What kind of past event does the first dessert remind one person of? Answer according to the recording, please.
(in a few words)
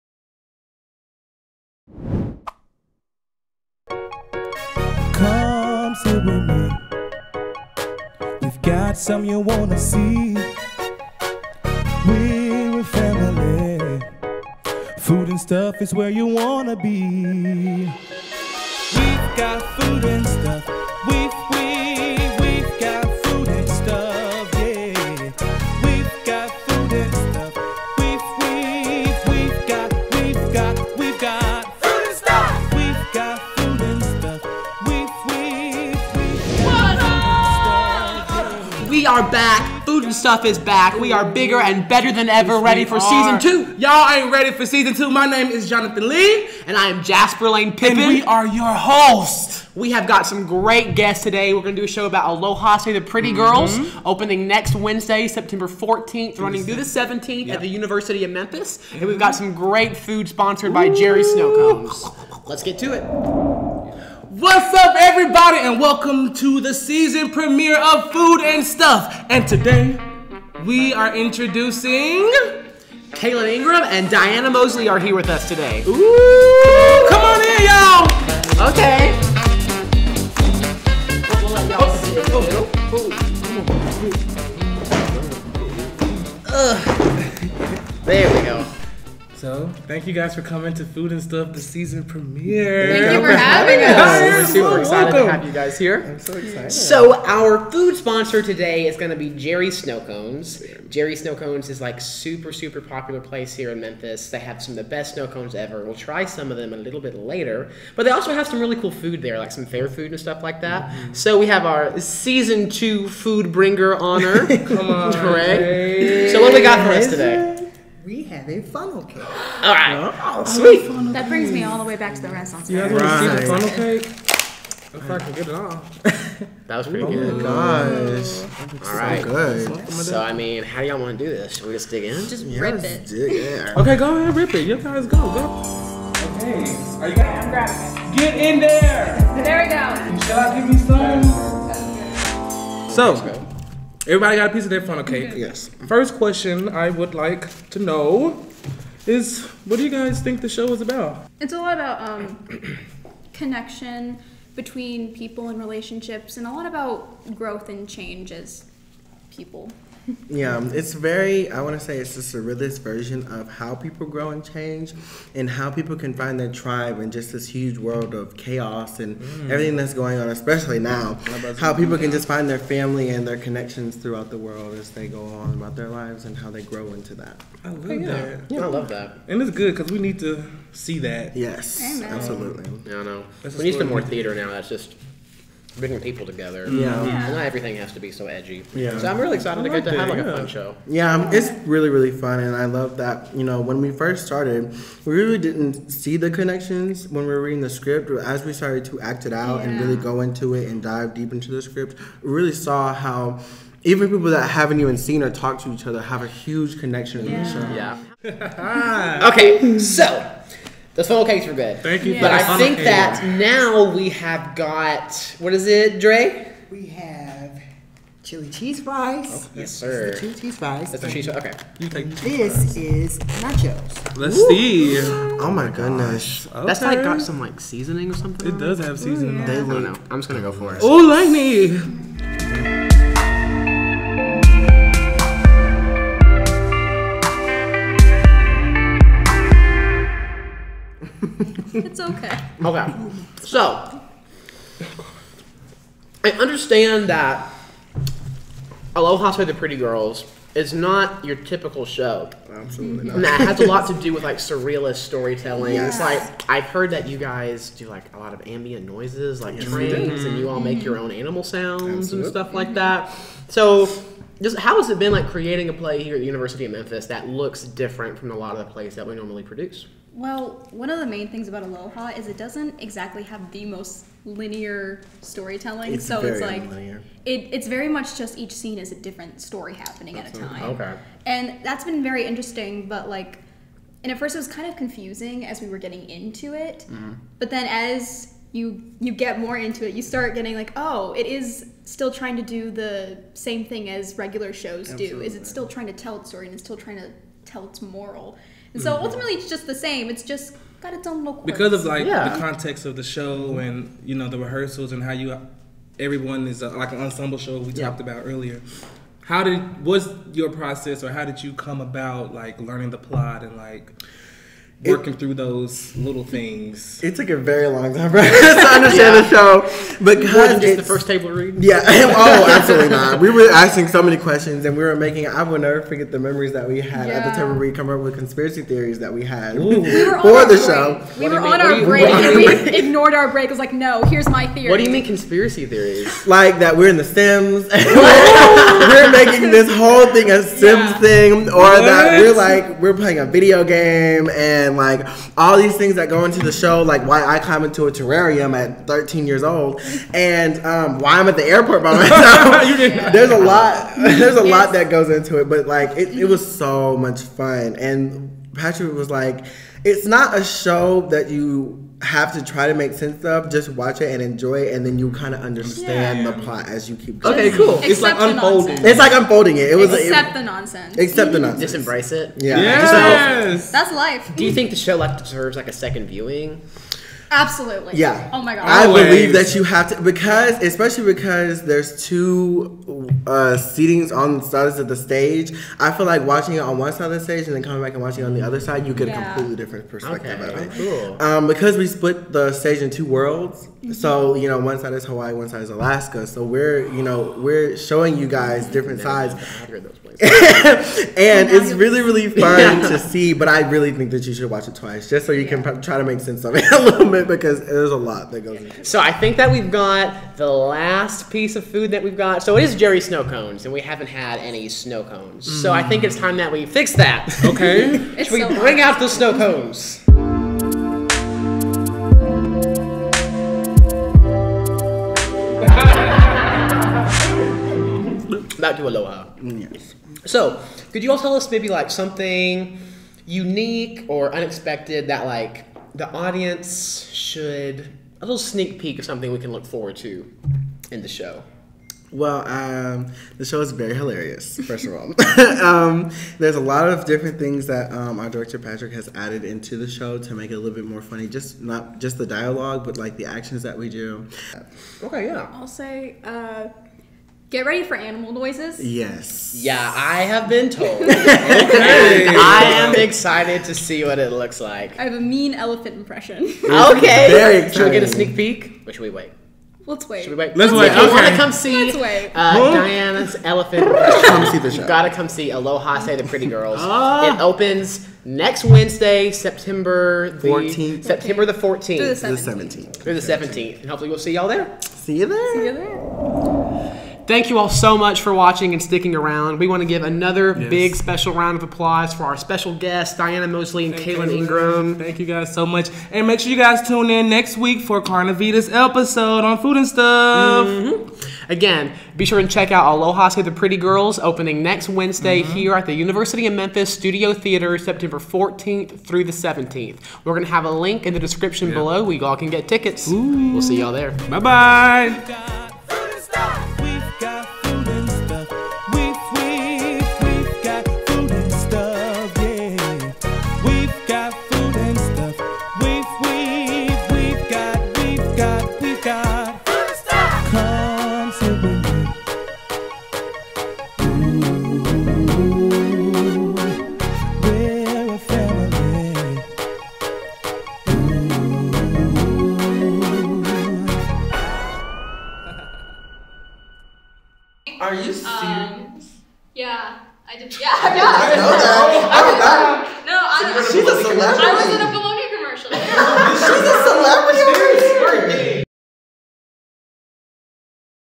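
Renaissance.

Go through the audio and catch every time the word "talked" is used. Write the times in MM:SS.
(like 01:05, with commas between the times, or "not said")
03:25, 05:07.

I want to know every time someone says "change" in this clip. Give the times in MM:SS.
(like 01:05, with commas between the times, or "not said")
02:37, 02:44.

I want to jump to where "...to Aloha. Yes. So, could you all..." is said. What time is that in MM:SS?
07:08.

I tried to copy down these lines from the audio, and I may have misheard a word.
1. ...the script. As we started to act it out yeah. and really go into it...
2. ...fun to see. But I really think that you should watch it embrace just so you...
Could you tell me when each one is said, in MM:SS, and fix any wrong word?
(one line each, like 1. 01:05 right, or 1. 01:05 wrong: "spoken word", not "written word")
1. 03:17 right
2. 06:42 wrong: "twice", not "embrace".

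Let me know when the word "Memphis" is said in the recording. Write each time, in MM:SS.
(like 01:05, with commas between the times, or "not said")
00:58, 01:43, 04:26, 08:26.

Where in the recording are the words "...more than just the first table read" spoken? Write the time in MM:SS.
05:20.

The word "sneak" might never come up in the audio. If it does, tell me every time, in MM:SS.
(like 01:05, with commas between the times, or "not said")
07:18, 07:48.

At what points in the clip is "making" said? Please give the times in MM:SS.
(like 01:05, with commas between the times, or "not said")
05:24, 05:39.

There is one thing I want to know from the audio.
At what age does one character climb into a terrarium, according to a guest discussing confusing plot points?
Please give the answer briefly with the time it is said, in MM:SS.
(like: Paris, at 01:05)
13, at 05:48.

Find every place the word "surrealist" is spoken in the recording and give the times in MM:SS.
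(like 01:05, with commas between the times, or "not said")
02:42, 04:14.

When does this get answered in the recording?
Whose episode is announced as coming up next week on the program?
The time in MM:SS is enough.
08:18.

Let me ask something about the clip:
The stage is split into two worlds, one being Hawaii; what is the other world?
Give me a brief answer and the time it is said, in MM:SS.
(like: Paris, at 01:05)
Alaska, at 06:35.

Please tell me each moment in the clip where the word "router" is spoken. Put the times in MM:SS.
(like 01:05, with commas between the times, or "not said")
not said.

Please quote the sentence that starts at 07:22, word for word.
Well, um, the show is very hilarious, first of all.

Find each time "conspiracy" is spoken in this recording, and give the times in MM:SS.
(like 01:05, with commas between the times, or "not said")
05:28, 05:35.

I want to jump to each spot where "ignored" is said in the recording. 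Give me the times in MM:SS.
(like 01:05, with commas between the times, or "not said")
05:32.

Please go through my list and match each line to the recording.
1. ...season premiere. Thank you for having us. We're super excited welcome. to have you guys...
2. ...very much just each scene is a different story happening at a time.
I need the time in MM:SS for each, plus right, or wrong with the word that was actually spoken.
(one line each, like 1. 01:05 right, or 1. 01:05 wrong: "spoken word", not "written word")
1. 01:31 right
2. 04:37 right.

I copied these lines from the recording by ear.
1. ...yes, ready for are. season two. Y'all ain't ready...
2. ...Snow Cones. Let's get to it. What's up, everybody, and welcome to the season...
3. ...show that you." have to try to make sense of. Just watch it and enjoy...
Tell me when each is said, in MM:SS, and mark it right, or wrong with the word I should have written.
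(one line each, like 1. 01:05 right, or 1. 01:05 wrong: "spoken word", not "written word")
1. 00:42 right
2. 01:01 right
3. 06:00 right.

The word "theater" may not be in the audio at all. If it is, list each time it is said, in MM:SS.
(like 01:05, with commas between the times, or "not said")
03:04, 08:27.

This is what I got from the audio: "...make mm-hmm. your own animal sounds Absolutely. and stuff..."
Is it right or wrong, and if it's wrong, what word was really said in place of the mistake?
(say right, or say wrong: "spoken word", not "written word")
right.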